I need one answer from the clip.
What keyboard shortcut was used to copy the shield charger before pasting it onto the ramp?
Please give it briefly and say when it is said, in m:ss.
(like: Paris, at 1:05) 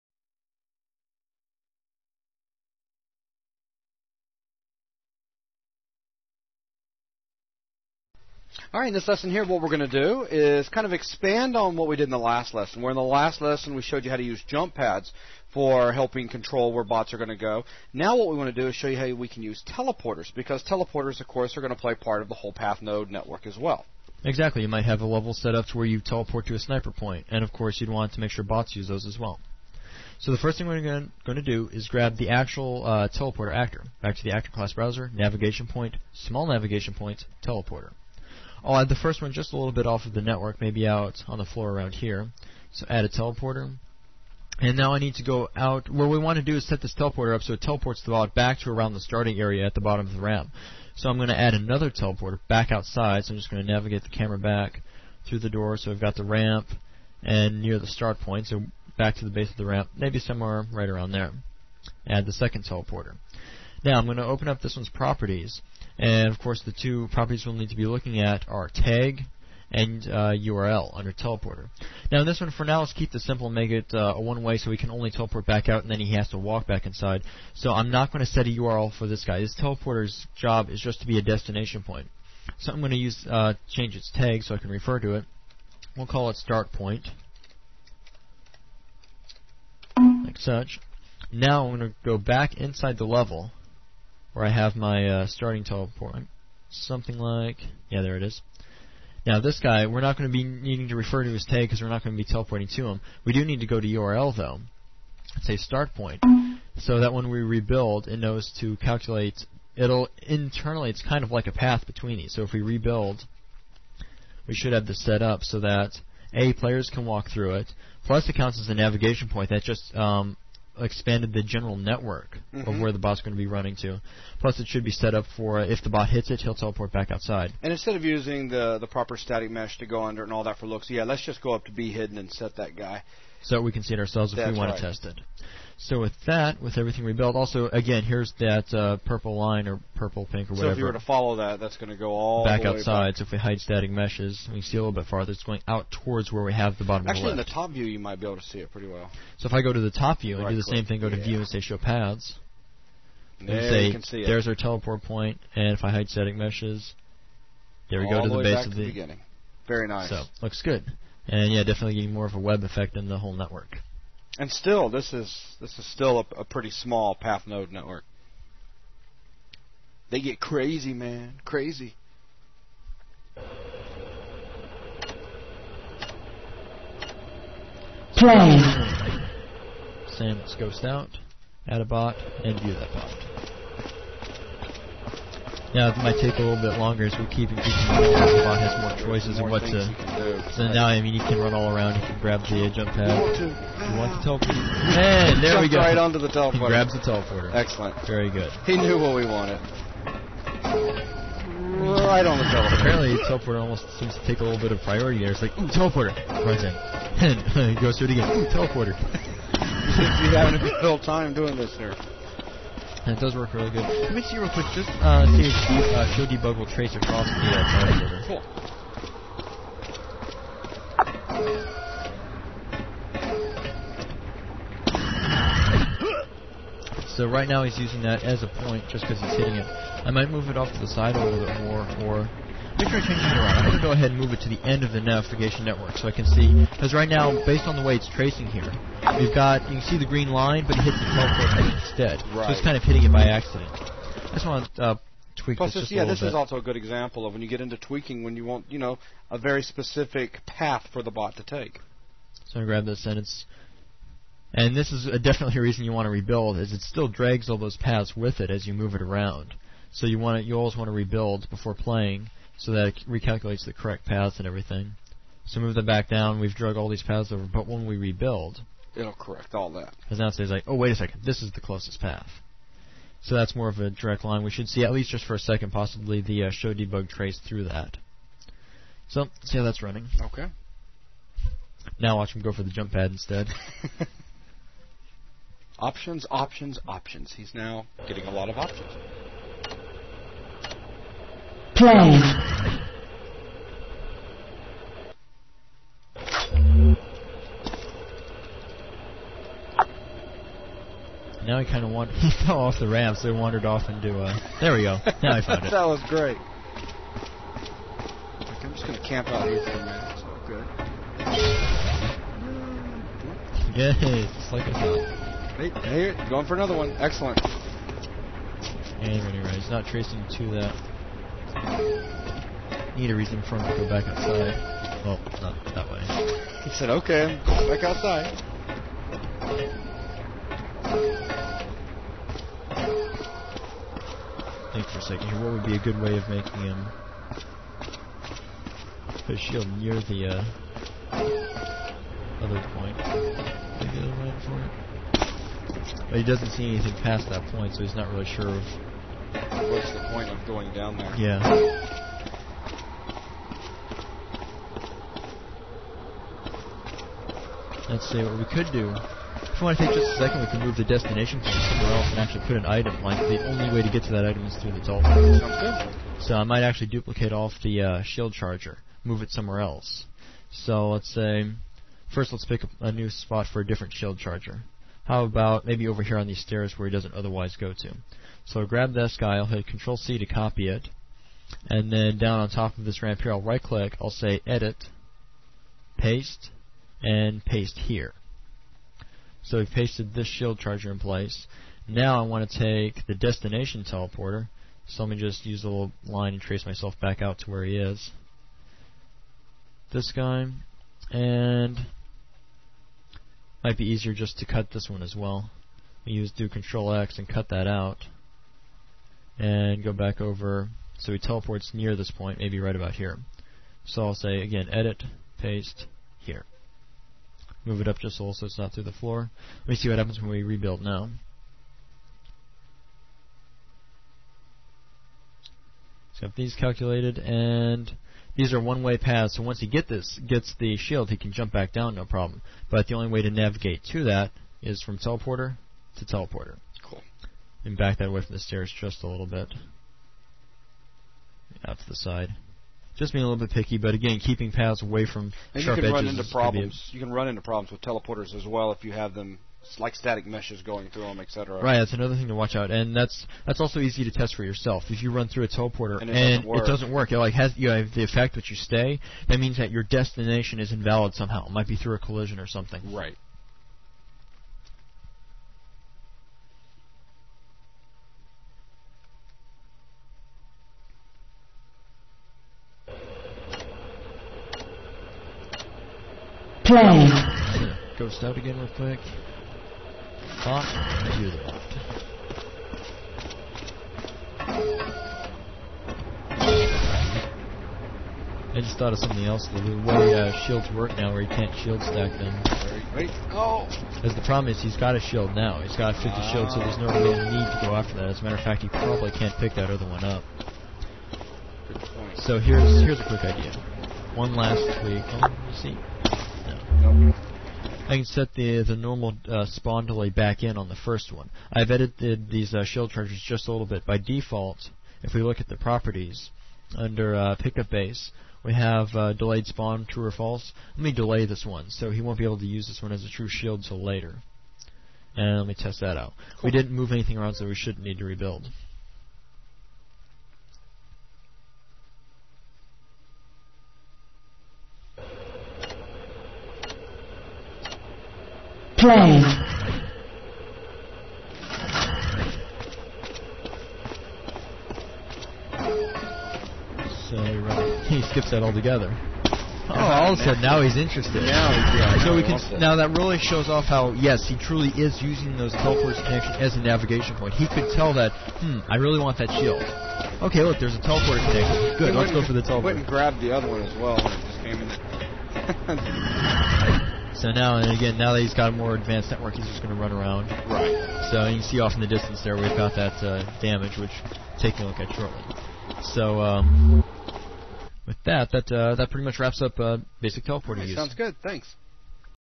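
Control C, at 6:19.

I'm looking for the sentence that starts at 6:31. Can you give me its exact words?
Now I want to take the destination teleporter.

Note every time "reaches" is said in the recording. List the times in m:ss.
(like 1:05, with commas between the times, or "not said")
not said.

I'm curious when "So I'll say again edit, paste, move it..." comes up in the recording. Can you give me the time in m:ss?
6:53.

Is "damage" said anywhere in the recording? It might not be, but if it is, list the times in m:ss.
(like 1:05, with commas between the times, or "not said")
9:33.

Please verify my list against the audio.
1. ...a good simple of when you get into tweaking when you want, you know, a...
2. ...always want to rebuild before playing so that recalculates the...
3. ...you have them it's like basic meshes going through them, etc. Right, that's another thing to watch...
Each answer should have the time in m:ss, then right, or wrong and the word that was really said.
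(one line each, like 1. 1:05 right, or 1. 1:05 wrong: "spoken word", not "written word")
1. 4:06 wrong: "example", not "simple"
2. 4:20 right
3. 7:28 wrong: "static", not "basic".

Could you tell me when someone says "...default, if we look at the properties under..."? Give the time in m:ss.
8:33.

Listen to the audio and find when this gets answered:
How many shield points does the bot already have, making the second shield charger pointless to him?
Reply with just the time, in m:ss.
8:15.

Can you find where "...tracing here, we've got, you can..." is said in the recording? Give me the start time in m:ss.
3:58.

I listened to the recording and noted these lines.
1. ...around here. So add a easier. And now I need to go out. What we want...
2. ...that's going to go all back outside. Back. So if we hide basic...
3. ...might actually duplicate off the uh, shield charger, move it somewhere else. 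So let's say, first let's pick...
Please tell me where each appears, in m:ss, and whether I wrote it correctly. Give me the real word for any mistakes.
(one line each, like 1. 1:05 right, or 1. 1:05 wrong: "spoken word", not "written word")
1. 0:41 wrong: "teleporter", not "easier"
2. 2:21 wrong: "static", not "basic"
3. 6:06 right.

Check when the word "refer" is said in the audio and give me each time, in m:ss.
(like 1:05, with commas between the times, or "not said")
1:24, 1:40.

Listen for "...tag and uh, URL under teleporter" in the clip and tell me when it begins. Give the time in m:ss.
1:08.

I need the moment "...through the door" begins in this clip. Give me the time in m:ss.
0:55.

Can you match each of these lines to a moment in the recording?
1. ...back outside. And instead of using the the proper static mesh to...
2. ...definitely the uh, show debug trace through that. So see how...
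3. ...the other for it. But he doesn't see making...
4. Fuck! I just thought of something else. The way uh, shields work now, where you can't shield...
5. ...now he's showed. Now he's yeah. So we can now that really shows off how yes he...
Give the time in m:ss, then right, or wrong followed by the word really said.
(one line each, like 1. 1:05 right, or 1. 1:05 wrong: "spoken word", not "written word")
1. 2:06 right
2. 4:35 wrong: "possibly", not "definitely"
3. 5:43 wrong: "anything", not "making"
4. 8:00 right
5. 9:10 wrong: "interested", not "showed".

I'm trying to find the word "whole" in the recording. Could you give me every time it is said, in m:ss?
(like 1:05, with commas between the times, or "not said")
0:22, 2:43.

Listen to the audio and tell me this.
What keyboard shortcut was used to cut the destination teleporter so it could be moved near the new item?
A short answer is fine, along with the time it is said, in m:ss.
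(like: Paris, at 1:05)
Control X, at 6:46.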